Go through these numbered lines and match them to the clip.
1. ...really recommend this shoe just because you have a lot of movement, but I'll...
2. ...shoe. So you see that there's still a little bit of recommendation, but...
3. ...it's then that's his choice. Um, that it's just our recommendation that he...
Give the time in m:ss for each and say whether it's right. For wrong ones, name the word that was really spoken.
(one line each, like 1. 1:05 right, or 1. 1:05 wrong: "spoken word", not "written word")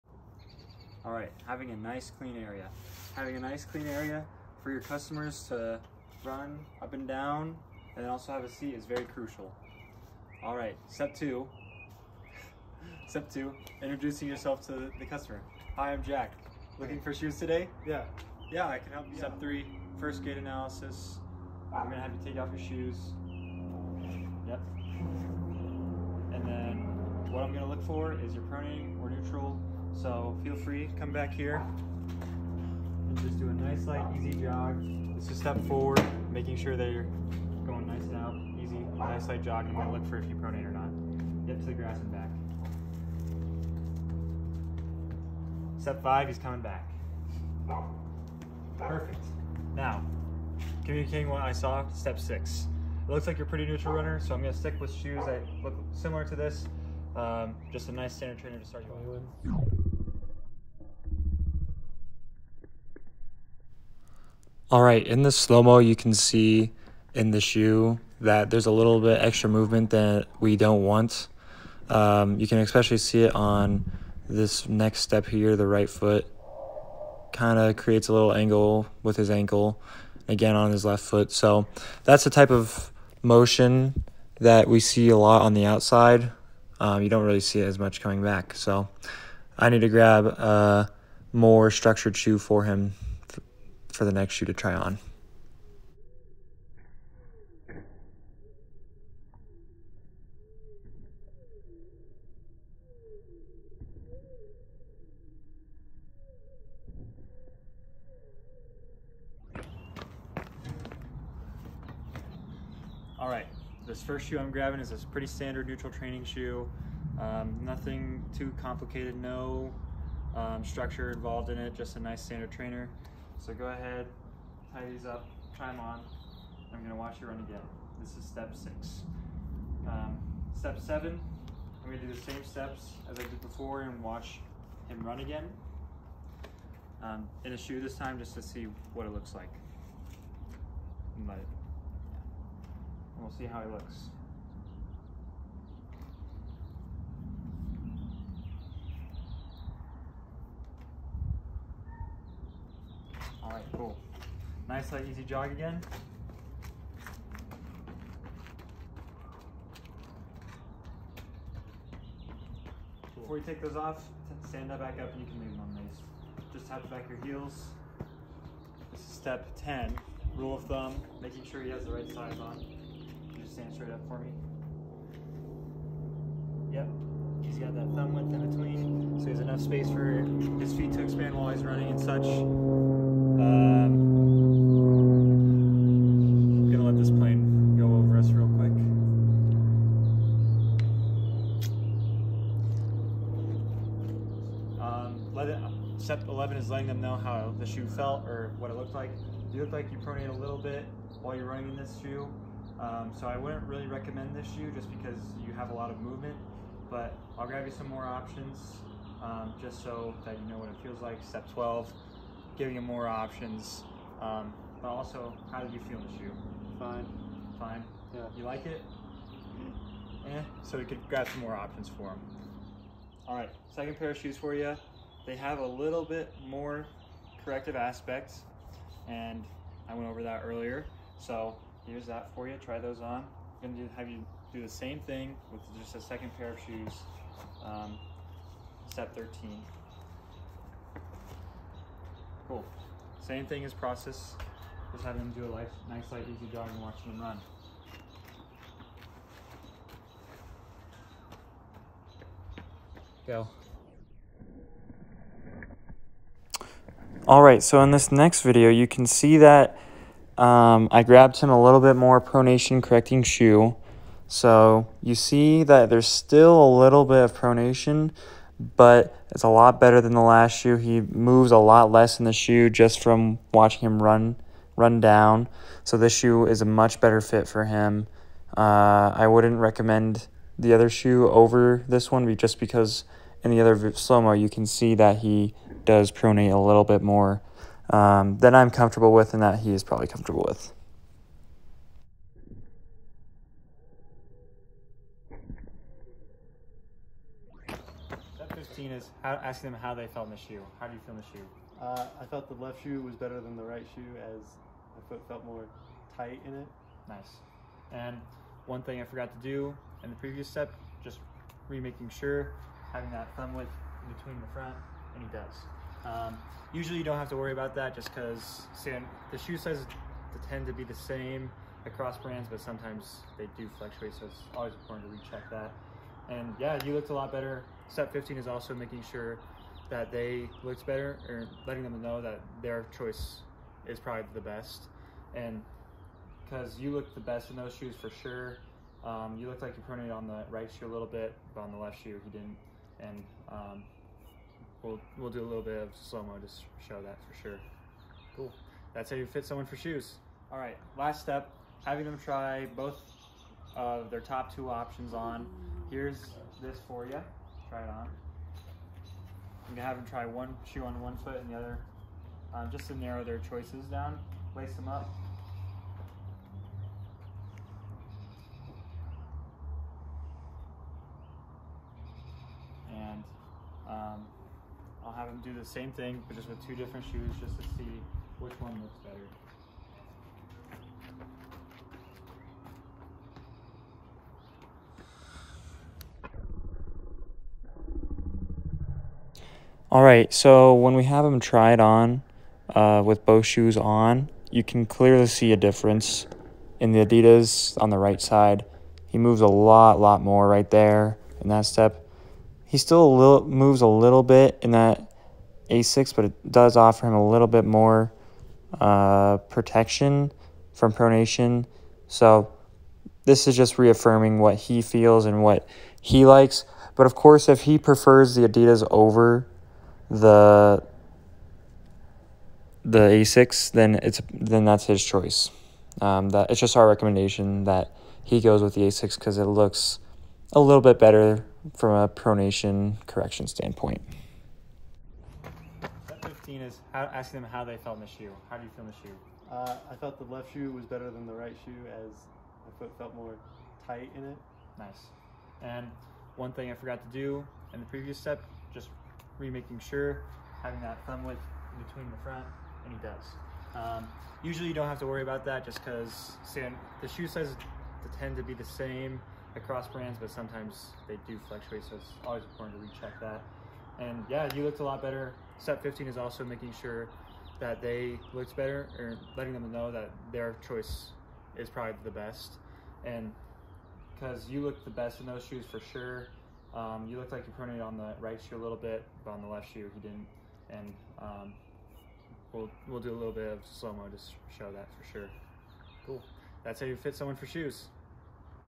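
1. 3:23 right
2. 4:23 wrong: "pronation", not "recommendation"
3. 7:04 right.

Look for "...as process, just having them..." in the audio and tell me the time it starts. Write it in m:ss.
4:03.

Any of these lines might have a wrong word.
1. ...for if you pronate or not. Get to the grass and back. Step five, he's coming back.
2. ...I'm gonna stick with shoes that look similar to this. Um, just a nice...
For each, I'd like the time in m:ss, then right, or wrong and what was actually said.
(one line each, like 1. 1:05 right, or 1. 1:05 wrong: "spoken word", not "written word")
1. 0:40 right
2. 0:54 right.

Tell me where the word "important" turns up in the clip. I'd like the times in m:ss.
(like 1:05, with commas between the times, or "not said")
5:24, 7:42.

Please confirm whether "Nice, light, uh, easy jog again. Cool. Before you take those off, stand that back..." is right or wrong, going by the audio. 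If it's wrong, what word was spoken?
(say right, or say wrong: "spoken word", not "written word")
right.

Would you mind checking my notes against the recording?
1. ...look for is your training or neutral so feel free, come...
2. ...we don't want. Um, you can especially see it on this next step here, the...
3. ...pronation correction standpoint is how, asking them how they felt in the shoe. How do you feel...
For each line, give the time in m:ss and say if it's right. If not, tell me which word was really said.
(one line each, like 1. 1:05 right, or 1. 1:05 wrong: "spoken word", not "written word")
1. 0:27 wrong: "pronating", not "training"
2. 1:10 right
3. 7:12 right.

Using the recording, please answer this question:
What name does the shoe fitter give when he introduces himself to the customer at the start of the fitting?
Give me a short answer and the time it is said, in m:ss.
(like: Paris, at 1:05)
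Jack, at 0:16.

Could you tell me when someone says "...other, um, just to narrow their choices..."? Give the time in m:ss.
6:01.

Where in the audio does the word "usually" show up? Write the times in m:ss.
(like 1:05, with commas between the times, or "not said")
5:16, 7:34.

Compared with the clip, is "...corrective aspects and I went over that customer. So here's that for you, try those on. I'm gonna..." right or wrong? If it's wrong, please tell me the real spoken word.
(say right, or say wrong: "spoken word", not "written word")
wrong: "earlier", not "customer".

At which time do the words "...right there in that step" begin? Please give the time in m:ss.
6:40.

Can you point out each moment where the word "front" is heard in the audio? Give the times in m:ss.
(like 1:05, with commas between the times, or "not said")
5:14, 7:32.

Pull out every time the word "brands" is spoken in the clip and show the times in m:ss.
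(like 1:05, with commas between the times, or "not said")
5:22, 7:39.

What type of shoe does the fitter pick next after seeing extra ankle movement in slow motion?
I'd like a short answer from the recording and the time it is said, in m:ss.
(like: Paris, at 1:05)
more structured shoe, at 1:31.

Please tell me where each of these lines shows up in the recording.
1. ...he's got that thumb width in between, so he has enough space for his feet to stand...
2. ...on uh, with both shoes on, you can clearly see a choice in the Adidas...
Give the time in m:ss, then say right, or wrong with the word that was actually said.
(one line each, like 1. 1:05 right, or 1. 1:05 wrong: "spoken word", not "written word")
1. 2:57 wrong: "expand", not "stand"
2. 6:31 wrong: "difference", not "choice".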